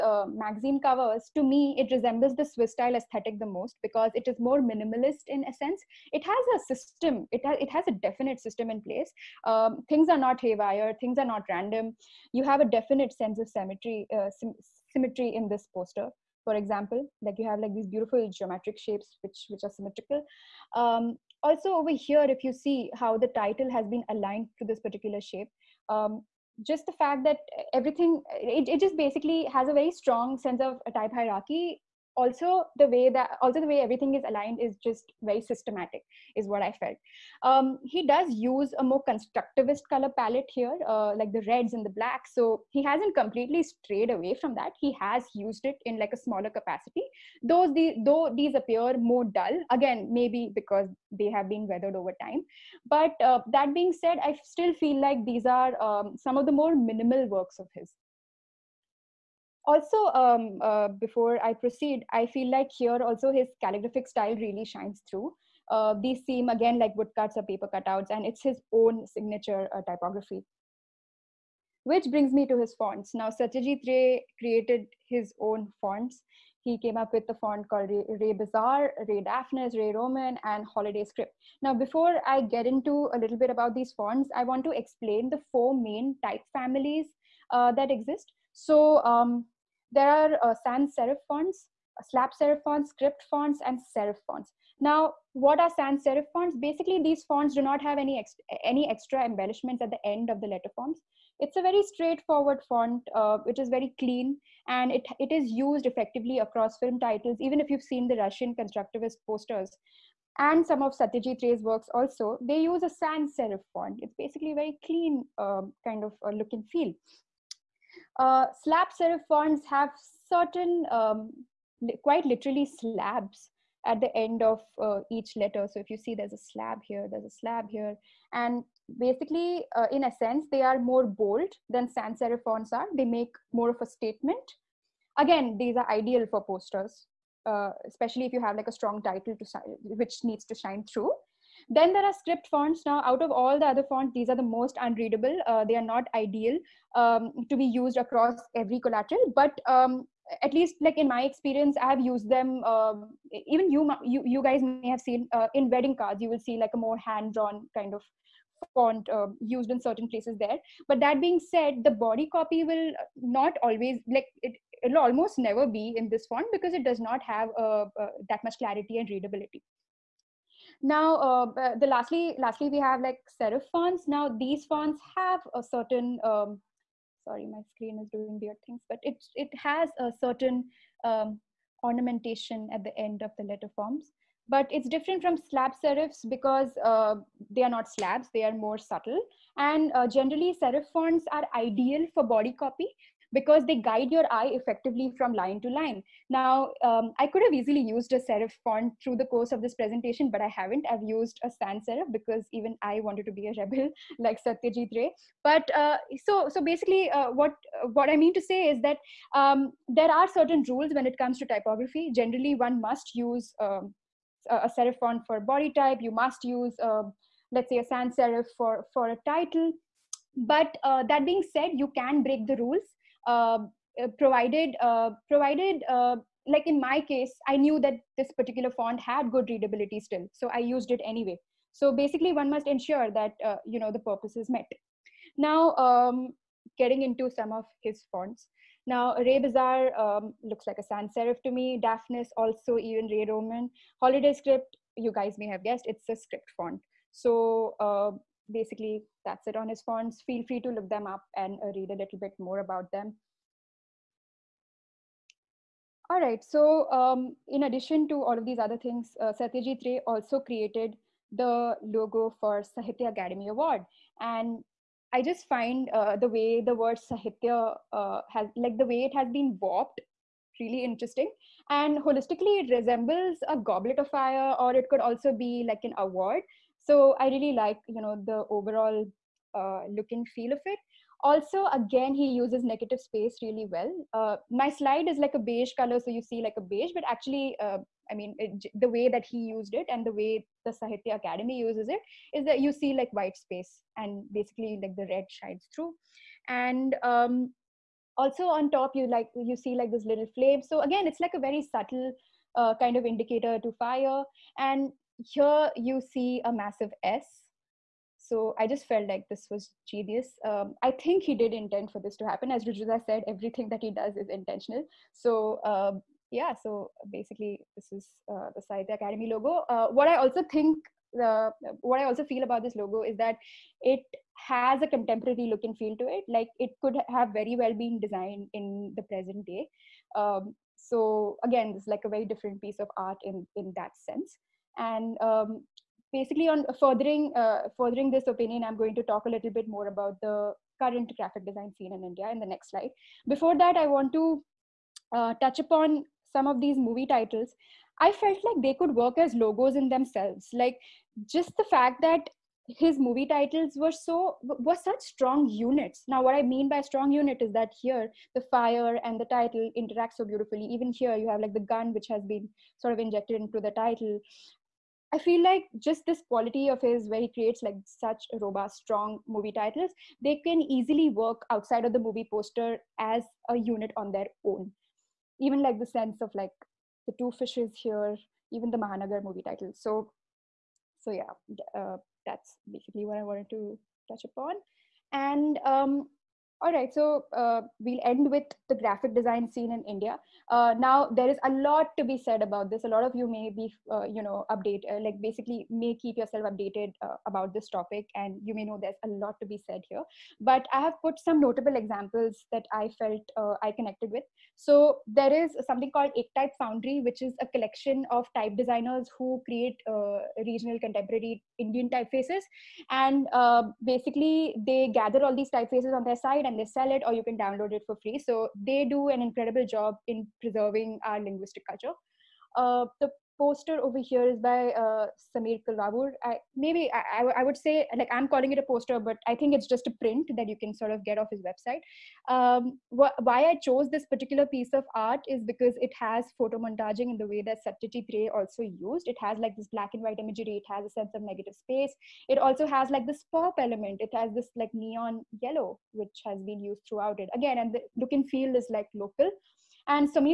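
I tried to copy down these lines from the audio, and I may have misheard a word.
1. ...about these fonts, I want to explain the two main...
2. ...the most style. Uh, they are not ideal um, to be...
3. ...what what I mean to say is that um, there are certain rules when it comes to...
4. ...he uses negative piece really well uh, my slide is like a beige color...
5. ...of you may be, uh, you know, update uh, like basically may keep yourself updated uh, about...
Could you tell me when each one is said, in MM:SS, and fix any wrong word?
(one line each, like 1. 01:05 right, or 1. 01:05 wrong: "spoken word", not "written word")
1. 01:23 wrong: "four", not "two"
2. 02:24 wrong: "unreadable", not "style"
3. 03:27 right
4. 04:42 wrong: "space", not "piece"
5. 06:33 right.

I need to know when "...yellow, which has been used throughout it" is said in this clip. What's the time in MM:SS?
07:25.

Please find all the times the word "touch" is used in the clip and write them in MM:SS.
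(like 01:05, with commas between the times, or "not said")
05:45, 06:24.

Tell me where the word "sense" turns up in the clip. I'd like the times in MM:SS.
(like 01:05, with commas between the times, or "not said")
00:05, 00:13, 00:30, 02:10, 05:33, 06:15, 07:20.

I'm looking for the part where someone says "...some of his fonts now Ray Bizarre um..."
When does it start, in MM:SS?
03:57.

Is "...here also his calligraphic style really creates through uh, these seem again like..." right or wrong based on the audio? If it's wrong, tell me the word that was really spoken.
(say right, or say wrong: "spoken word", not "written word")
wrong: "shines", not "creates".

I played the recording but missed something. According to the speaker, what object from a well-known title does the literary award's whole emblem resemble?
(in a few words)
A goblet of fire.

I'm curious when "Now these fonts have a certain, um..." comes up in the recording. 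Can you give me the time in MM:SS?
02:54.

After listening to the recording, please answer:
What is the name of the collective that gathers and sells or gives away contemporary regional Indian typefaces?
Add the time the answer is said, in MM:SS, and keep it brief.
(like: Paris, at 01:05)
Ek Type Foundry, at 06:46.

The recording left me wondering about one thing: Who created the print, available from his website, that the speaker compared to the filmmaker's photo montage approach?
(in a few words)
Sameer Kulavoor.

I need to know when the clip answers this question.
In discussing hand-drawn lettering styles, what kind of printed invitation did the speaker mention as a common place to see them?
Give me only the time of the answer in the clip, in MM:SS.
02:35.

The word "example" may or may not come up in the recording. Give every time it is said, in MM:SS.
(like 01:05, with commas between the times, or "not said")
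00:16, 06:41.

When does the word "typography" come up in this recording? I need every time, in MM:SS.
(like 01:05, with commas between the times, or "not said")
01:09, 03:31.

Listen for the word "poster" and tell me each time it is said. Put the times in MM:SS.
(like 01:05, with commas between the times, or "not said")
00:15, 01:49, 02:16, 06:12, 07:03, 07:08.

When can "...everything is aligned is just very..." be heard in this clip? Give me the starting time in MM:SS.
00:33.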